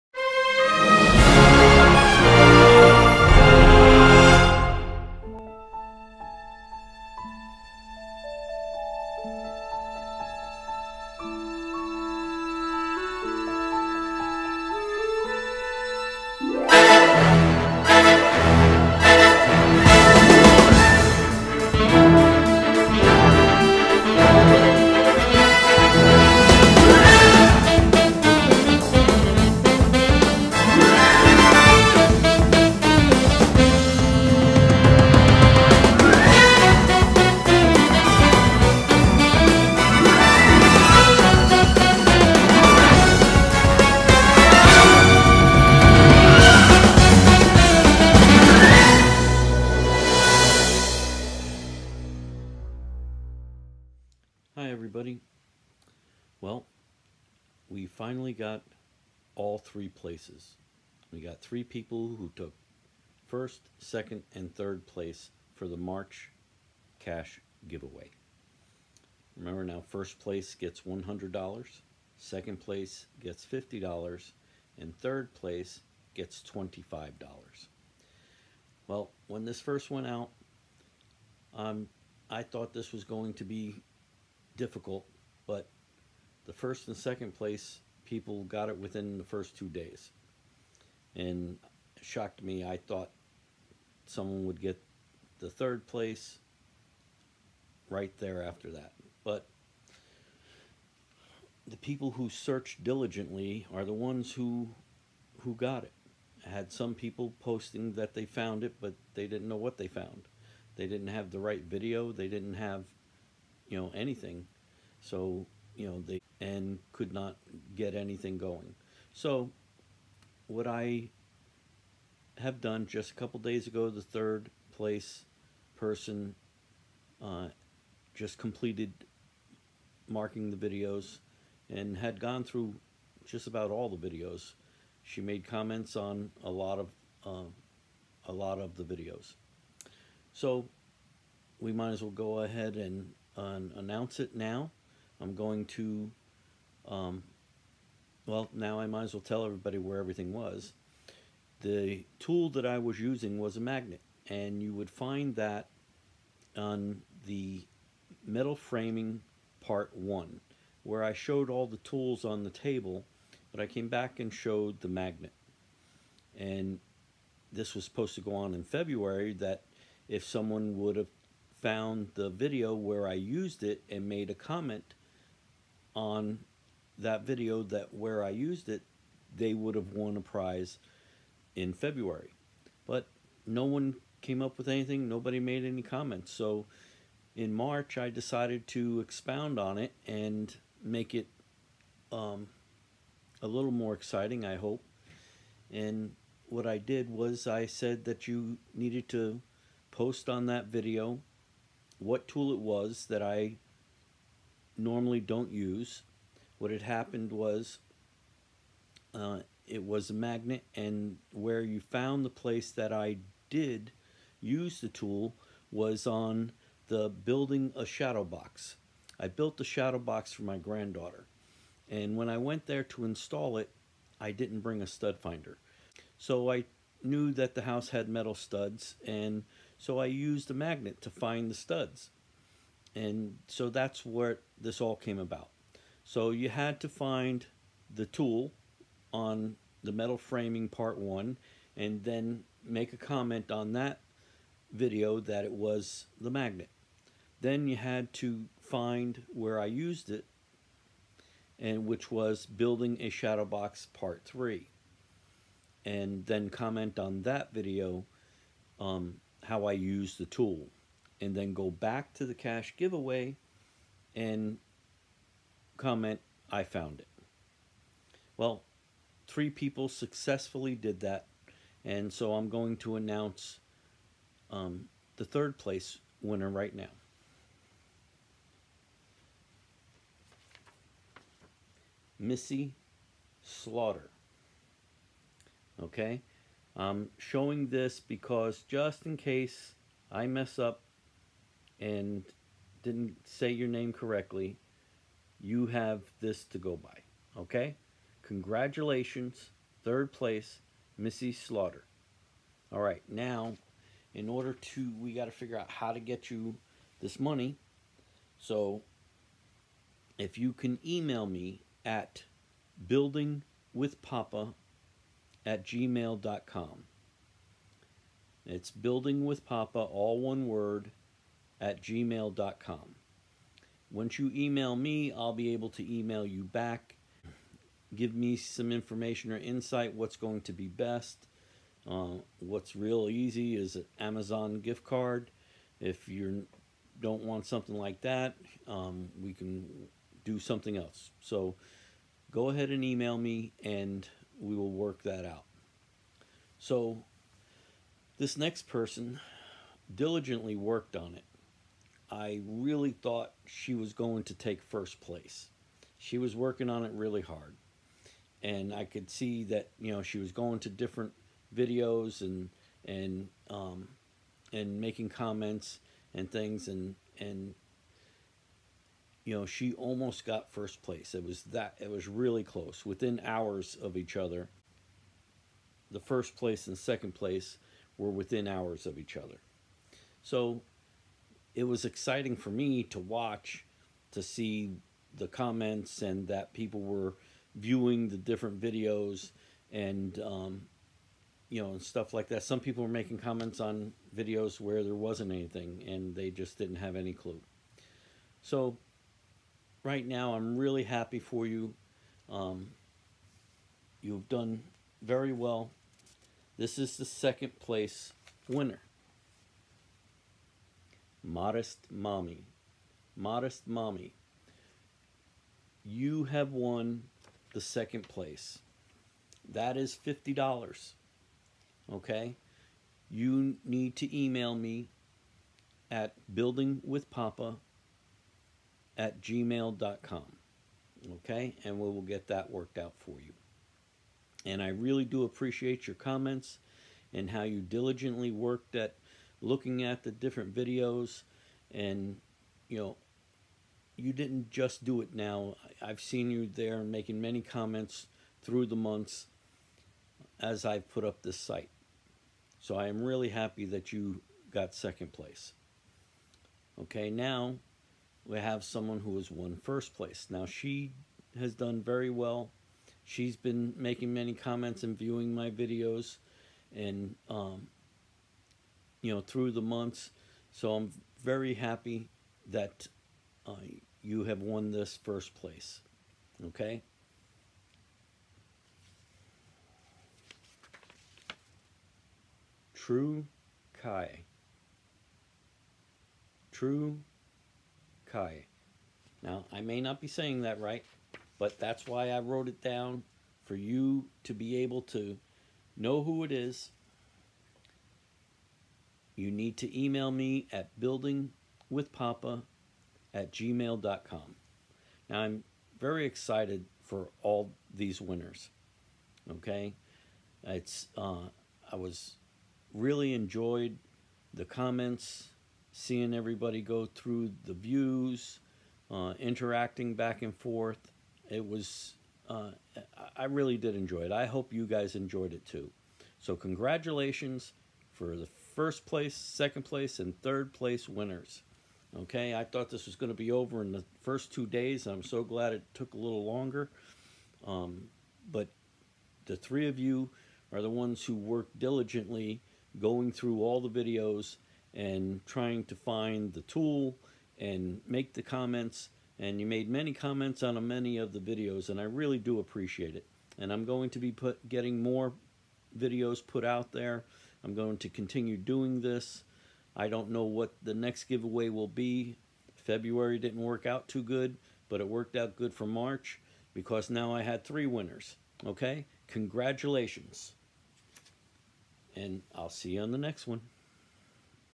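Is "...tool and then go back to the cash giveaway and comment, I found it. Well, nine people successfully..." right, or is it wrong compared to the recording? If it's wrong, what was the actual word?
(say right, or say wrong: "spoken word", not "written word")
wrong: "three", not "nine".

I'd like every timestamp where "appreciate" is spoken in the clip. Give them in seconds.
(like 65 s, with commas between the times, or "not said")
435 s, 552 s.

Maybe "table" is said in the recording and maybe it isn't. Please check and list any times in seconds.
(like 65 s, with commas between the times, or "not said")
162 s.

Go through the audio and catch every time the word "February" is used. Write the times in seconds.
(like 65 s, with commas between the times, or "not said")
168 s, 181 s, 562 s.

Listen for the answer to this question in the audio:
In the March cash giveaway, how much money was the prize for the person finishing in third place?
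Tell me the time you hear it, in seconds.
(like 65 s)
74 s.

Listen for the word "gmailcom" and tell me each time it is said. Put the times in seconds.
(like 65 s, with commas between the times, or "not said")
315 s, 321 s, 429 s, 503 s.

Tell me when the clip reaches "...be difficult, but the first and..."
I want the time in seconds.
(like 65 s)
83 s.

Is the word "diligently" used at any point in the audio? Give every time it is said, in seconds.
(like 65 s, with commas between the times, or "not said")
102 s, 349 s, 437 s, 541 s.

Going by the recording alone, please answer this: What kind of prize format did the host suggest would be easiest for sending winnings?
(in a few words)
Amazon gift card.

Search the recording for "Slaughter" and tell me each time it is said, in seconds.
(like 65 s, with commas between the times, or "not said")
283 s, 301 s.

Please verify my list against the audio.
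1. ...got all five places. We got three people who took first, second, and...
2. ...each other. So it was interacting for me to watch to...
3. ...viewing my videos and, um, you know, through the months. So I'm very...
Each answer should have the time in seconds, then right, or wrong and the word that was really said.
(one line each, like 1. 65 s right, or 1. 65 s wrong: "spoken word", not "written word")
1. 58 s wrong: "three", not "five"
2. 378 s wrong: "exciting", not "interacting"
3. 464 s right.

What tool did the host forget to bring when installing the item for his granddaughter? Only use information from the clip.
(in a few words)
stud finder.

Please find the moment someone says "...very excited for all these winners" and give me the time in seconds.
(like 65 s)
505 s.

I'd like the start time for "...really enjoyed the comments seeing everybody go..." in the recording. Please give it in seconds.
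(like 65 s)
512 s.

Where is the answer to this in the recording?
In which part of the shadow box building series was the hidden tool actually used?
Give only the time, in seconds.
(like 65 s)
253 s.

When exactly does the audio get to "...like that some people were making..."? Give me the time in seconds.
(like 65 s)
392 s.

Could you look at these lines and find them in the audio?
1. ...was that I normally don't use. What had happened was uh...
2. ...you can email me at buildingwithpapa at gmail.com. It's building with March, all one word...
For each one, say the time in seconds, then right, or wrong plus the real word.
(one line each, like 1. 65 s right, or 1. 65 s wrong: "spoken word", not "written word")
1. 202 s right
2. 310 s wrong: "Papa", not "March".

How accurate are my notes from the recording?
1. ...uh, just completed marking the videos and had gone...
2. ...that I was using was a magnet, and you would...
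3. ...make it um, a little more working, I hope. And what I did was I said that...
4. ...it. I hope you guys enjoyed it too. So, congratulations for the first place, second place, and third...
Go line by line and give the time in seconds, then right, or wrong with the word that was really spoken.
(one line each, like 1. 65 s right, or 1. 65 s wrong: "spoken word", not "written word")
1. 127 s right
2. 152 s right
3. 190 s wrong: "exciting", not "working"
4. 524 s right.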